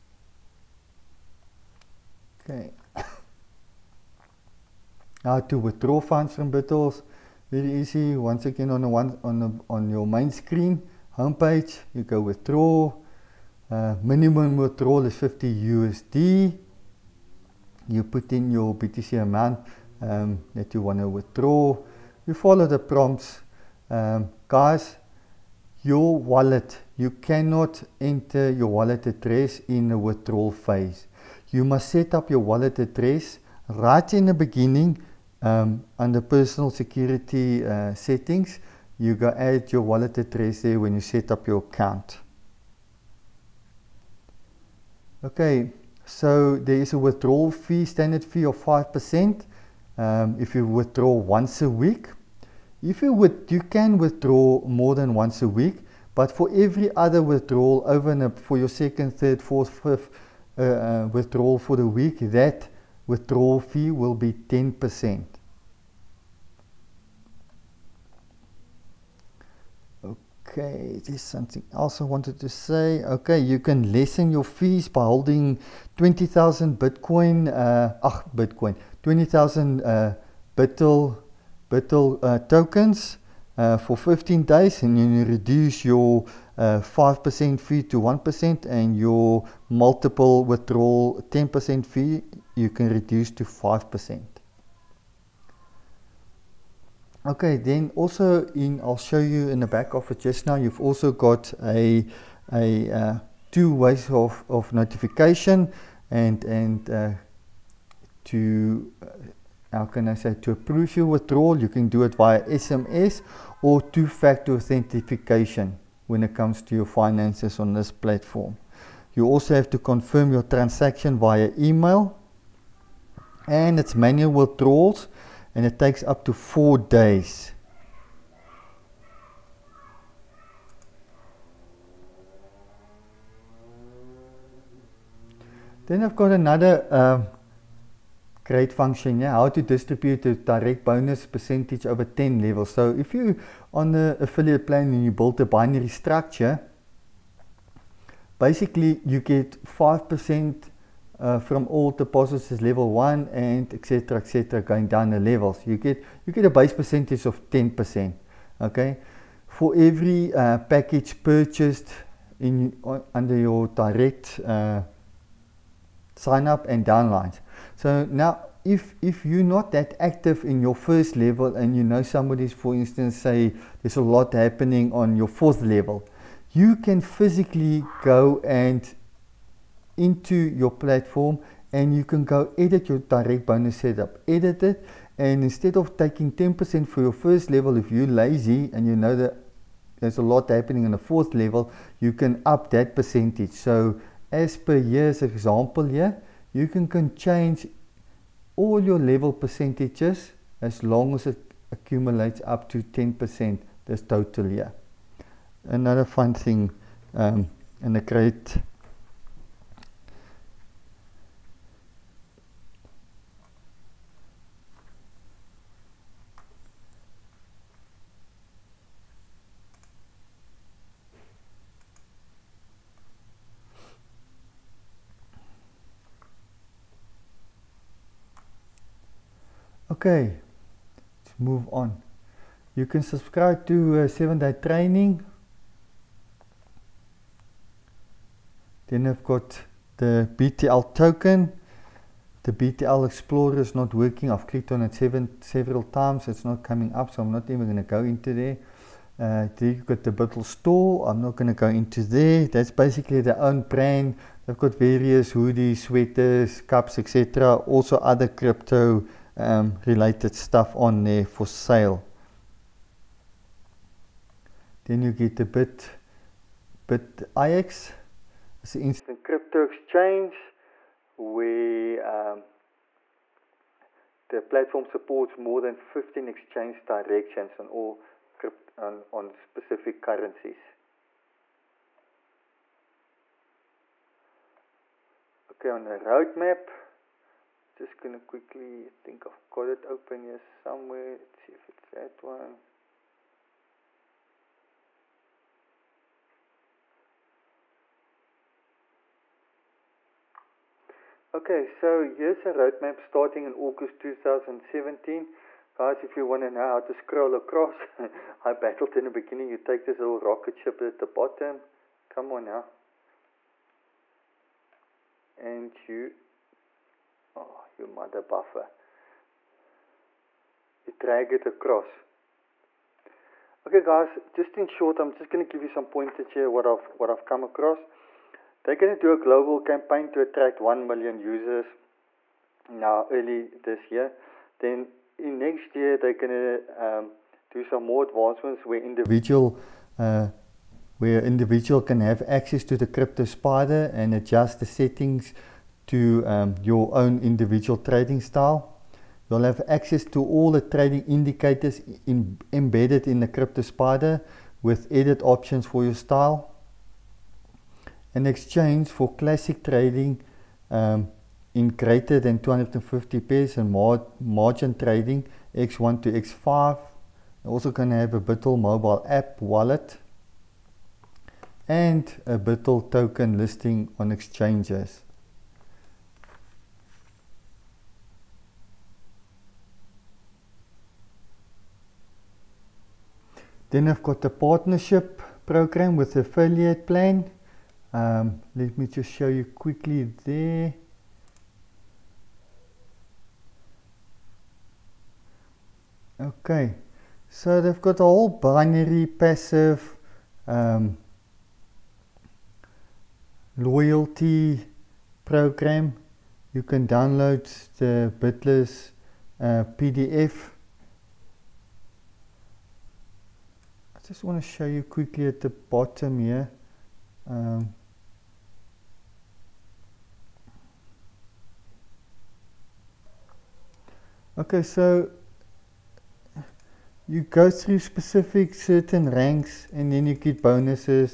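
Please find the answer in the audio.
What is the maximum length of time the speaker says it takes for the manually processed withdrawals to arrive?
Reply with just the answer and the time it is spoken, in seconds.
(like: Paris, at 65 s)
4 days, at 126 s.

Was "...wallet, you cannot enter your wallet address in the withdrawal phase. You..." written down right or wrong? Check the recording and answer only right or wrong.
right.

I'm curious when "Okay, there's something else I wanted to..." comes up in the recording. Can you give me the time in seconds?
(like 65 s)
70 s.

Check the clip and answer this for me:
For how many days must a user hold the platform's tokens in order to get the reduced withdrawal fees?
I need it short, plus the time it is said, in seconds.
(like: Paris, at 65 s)
15 days, at 83 s.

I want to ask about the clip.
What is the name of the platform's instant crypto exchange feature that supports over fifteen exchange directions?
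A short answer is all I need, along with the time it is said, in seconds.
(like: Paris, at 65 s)
Bit IX, at 265 s.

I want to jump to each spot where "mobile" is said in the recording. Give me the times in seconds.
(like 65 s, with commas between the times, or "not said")
368 s.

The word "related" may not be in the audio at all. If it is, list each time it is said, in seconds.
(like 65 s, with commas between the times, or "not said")
259 s.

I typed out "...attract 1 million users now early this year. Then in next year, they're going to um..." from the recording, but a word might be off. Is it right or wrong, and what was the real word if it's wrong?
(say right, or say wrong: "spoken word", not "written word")
right.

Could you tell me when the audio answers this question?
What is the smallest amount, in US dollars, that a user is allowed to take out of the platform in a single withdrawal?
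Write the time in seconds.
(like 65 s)
15 s.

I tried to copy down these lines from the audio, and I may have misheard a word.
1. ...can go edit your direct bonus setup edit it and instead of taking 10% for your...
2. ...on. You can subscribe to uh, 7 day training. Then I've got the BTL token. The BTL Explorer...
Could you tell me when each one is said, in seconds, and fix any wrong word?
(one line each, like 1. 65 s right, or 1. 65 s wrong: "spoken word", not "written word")
1. 182 s right
2. 231 s right.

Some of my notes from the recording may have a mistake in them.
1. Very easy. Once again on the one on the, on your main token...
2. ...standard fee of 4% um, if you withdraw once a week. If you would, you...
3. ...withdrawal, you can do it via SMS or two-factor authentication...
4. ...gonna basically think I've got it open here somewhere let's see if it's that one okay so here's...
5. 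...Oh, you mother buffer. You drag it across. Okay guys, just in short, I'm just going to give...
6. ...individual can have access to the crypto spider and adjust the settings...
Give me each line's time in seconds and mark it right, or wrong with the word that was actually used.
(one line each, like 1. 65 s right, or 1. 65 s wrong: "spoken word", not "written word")
1. 7 s wrong: "screen", not "token"
2. 47 s wrong: "5", not "4"
3. 111 s right
4. 288 s wrong: "quickly", not "basically"
5. 317 s right
6. 341 s right.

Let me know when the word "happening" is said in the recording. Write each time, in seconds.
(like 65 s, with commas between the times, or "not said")
174 s, 190 s.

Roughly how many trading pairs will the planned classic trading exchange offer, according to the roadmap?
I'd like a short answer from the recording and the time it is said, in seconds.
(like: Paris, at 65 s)
more than 250, at 361 s.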